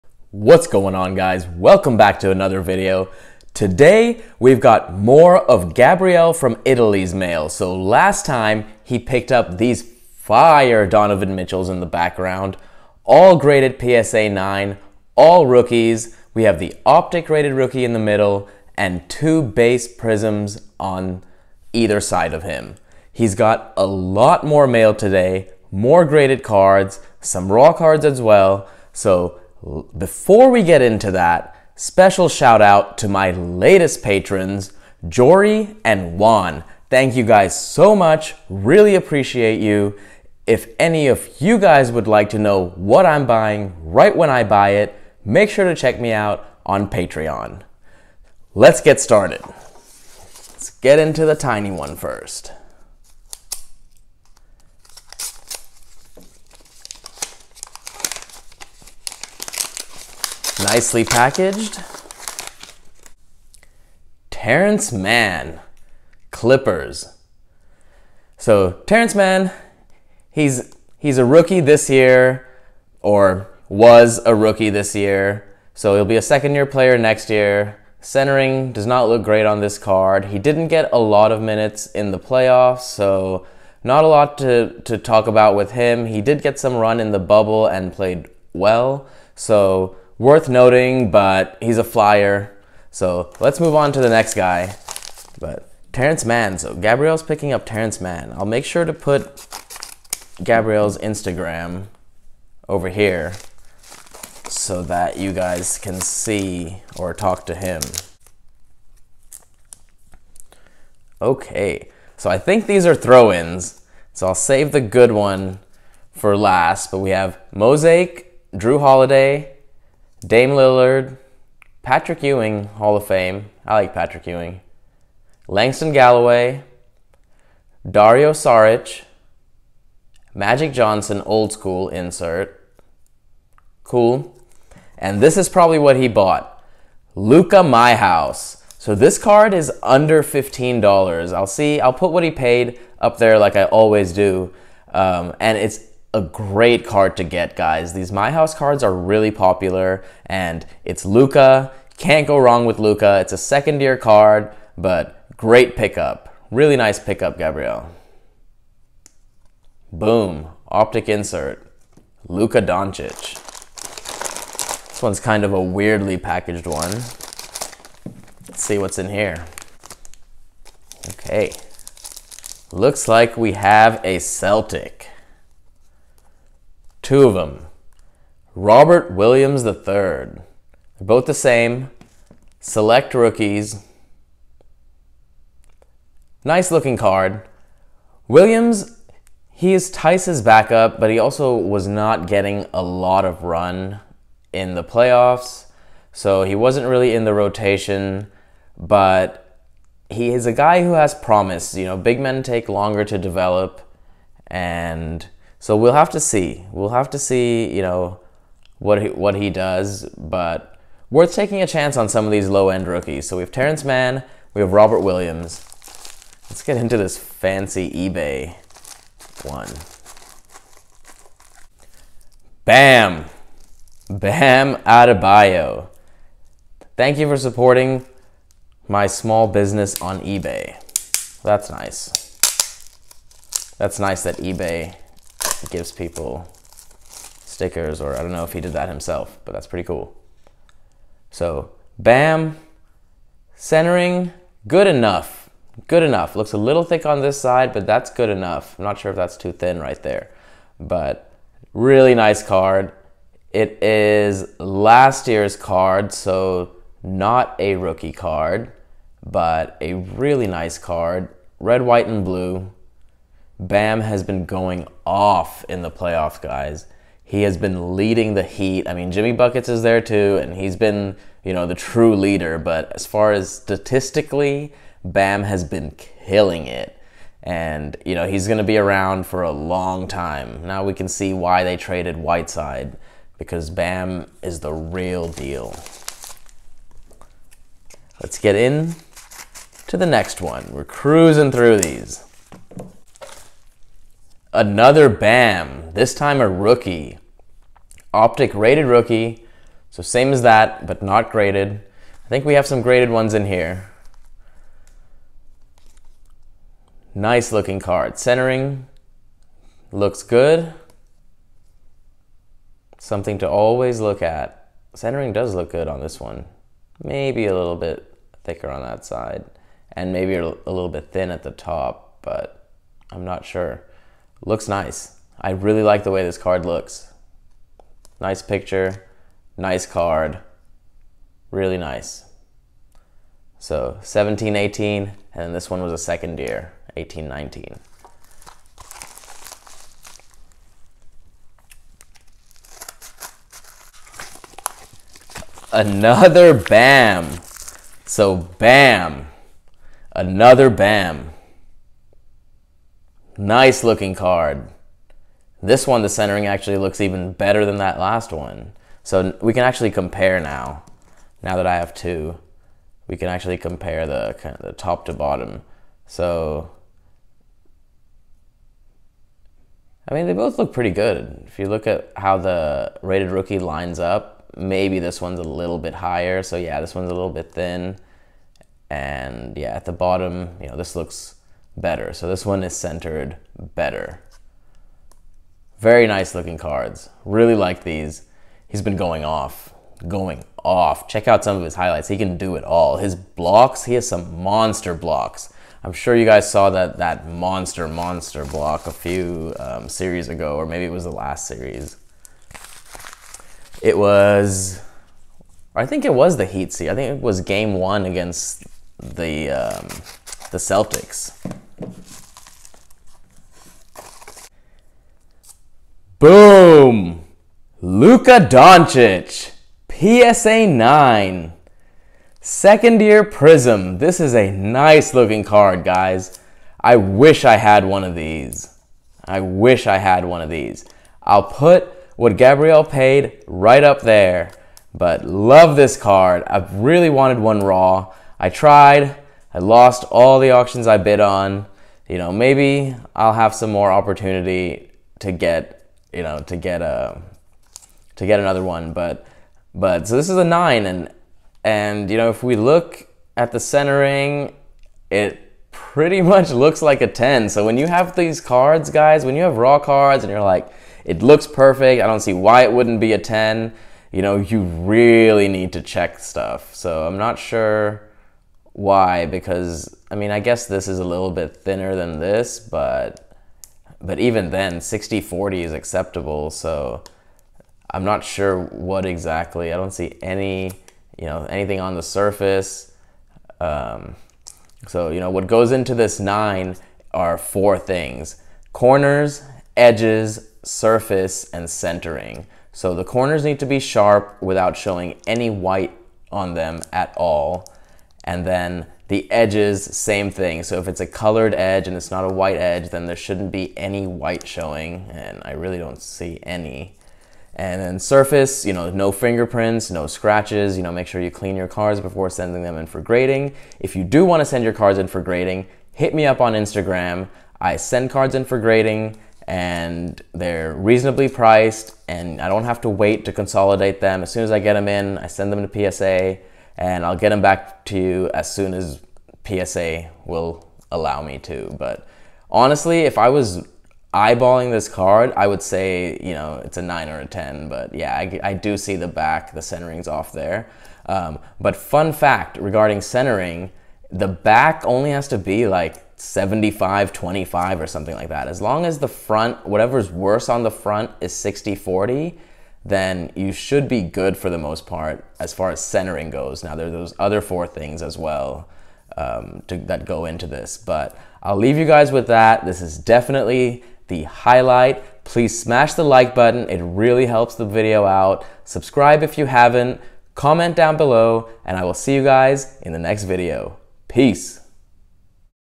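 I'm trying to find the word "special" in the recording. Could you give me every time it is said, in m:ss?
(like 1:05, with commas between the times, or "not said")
0:31.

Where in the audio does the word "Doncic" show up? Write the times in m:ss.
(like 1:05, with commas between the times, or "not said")
2:42, 6:58.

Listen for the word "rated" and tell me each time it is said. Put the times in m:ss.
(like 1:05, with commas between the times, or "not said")
0:17, 4:58, 6:13.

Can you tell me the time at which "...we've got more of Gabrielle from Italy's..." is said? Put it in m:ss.
0:04.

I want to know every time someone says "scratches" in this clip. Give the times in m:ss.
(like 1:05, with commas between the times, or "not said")
8:30.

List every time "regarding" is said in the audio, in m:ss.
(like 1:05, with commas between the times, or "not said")
9:02.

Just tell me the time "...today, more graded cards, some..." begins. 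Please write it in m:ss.
0:24.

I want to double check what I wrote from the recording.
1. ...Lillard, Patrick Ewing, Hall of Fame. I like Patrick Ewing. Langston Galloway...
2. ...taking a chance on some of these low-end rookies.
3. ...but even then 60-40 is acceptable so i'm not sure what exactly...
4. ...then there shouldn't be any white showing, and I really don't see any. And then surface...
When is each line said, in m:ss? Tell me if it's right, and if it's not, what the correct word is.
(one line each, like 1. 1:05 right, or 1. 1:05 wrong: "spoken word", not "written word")
1. 2:00 right
2. 3:31 right
3. 7:54 right
4. 8:22 right.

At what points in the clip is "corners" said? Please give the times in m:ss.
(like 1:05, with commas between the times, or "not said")
8:08, 8:13.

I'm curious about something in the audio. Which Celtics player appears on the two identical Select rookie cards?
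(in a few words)
Robert Williams III.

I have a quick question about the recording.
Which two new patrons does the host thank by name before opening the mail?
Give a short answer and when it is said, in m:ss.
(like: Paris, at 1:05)
Jory and Juan, at 0:35.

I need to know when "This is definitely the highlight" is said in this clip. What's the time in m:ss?
9:22.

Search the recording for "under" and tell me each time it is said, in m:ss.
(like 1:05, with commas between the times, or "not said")
2:19.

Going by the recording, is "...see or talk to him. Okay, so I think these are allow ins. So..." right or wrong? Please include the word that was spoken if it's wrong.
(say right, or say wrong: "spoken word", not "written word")
wrong: "throw", not "allow".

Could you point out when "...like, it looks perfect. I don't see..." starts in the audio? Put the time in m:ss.
7:40.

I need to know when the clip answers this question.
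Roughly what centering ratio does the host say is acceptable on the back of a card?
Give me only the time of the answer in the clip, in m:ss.
9:06.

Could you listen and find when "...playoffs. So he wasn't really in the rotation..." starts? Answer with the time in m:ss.
3:14.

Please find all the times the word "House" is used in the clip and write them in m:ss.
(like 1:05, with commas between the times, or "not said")
2:17, 2:28.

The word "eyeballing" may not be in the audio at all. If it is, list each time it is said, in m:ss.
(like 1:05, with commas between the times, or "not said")
8:54.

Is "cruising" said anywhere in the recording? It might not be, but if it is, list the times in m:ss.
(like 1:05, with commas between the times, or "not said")
4:50.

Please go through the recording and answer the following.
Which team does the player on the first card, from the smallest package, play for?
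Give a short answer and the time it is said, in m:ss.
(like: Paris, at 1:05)
Clippers, at 1:06.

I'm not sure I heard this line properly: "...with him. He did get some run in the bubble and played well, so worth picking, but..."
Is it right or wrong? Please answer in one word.
wrong.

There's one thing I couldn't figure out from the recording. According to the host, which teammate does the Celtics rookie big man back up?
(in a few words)
Theis.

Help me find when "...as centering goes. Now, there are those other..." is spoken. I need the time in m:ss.
9:15.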